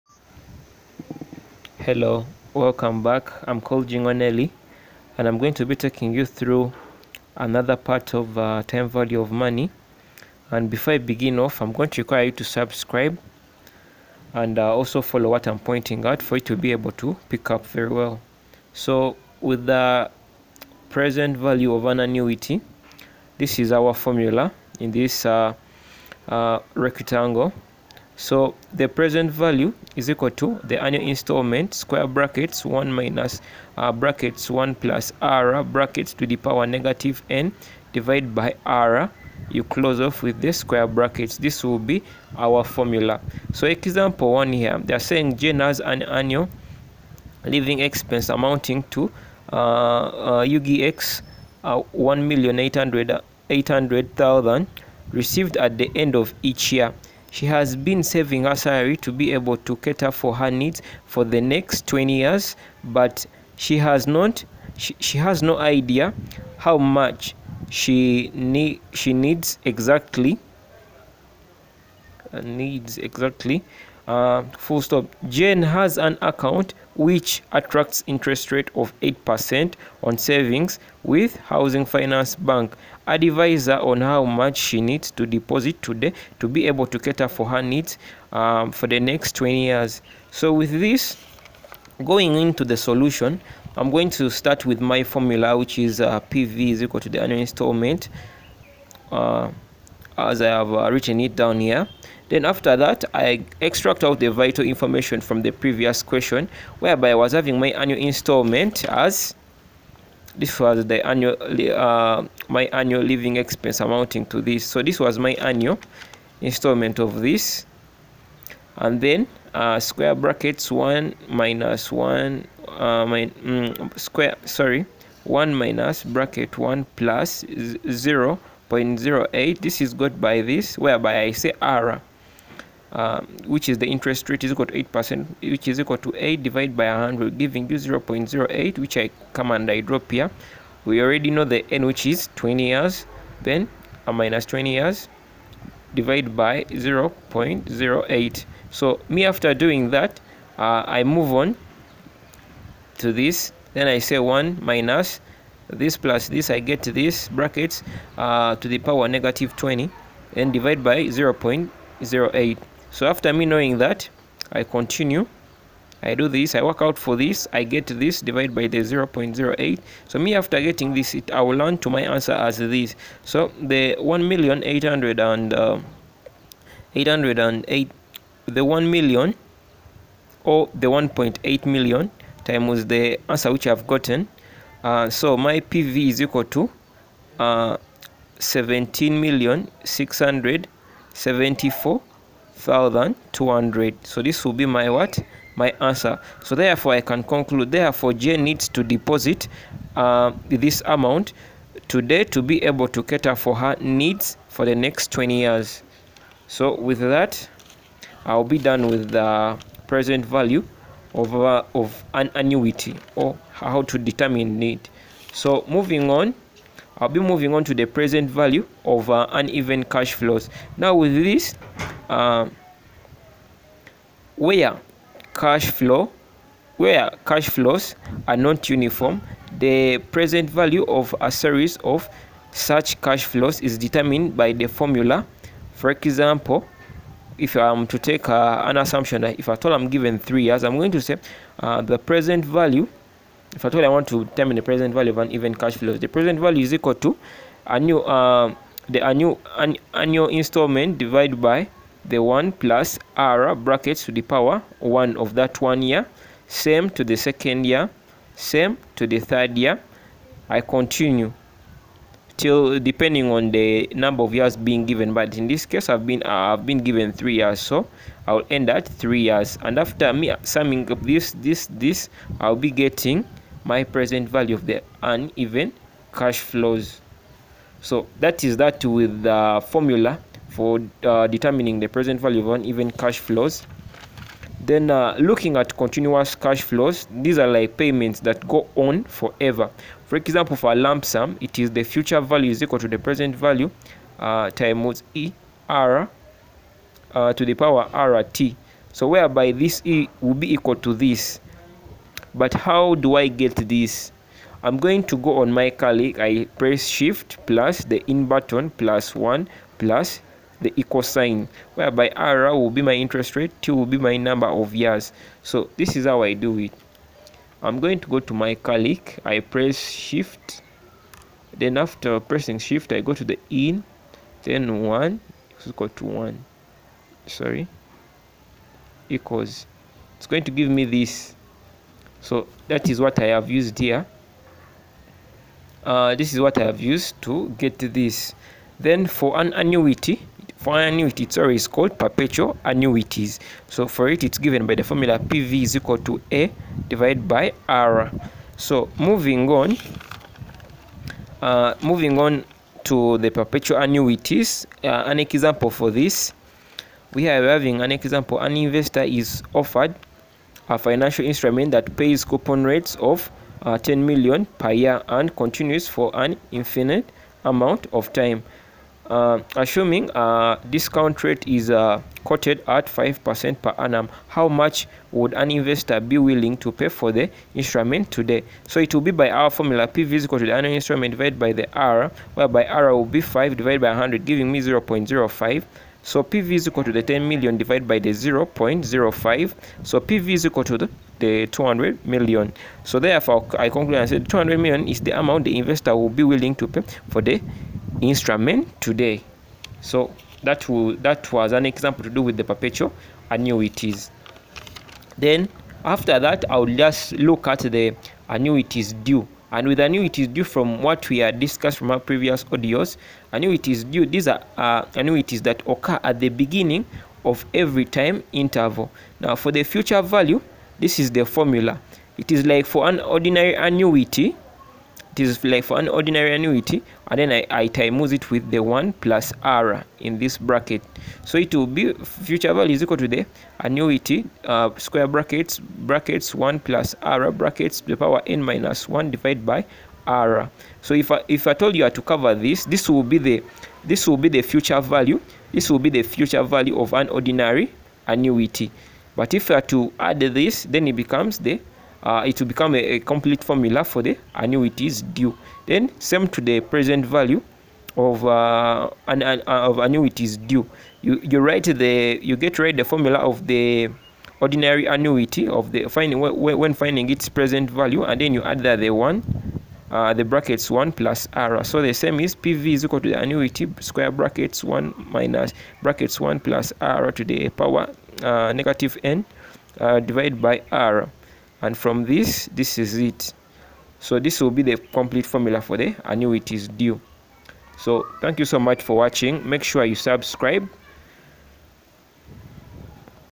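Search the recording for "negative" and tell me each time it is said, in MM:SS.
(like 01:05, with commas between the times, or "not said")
00:36, 02:39, 07:58.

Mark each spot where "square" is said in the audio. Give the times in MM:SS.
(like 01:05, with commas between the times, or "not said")
00:31, 00:40, 01:59, 02:03, 07:14, 07:53.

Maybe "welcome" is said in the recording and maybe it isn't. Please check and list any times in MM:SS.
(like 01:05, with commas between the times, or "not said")
00:02.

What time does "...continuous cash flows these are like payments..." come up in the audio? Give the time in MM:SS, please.
04:45.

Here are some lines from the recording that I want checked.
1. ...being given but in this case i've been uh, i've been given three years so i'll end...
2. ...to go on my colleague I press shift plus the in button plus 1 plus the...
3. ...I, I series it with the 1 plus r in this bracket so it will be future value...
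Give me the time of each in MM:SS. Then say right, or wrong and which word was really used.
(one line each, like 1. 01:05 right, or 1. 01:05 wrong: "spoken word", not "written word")
1. 04:24 right
2. 05:05 right
3. 07:07 wrong: "times", not "series".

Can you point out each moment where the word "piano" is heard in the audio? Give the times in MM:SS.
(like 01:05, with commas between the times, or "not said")
not said.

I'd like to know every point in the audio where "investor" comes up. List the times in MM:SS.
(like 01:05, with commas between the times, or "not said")
05:58, 06:15, 06:35.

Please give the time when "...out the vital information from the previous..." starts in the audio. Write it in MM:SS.
01:44.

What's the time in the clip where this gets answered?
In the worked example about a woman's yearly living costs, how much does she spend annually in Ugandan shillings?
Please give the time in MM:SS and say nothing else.
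00:51.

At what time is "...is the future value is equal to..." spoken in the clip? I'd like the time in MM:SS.
04:51.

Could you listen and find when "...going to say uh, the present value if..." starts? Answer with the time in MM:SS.
04:00.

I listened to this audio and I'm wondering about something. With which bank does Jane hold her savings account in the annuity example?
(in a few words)
Housing Finance Bank.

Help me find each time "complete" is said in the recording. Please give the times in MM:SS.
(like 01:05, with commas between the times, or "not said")
07:32, 08:04.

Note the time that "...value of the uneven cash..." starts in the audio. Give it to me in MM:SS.
04:34.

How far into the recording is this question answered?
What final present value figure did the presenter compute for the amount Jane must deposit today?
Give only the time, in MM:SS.
03:08.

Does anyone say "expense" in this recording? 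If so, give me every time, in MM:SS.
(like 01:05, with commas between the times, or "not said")
00:47, 01:53.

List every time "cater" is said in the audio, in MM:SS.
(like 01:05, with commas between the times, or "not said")
00:59, 01:26, 03:23.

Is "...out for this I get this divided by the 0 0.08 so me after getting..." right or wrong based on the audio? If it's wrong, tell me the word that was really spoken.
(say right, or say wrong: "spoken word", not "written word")
right.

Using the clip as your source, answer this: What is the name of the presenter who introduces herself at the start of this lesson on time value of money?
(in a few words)
Jingo Nelly.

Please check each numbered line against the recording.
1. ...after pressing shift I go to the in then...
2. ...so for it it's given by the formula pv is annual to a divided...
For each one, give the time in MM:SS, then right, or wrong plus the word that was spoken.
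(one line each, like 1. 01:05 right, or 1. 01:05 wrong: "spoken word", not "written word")
1. 05:21 right
2. 05:43 wrong: "equal", not "annual".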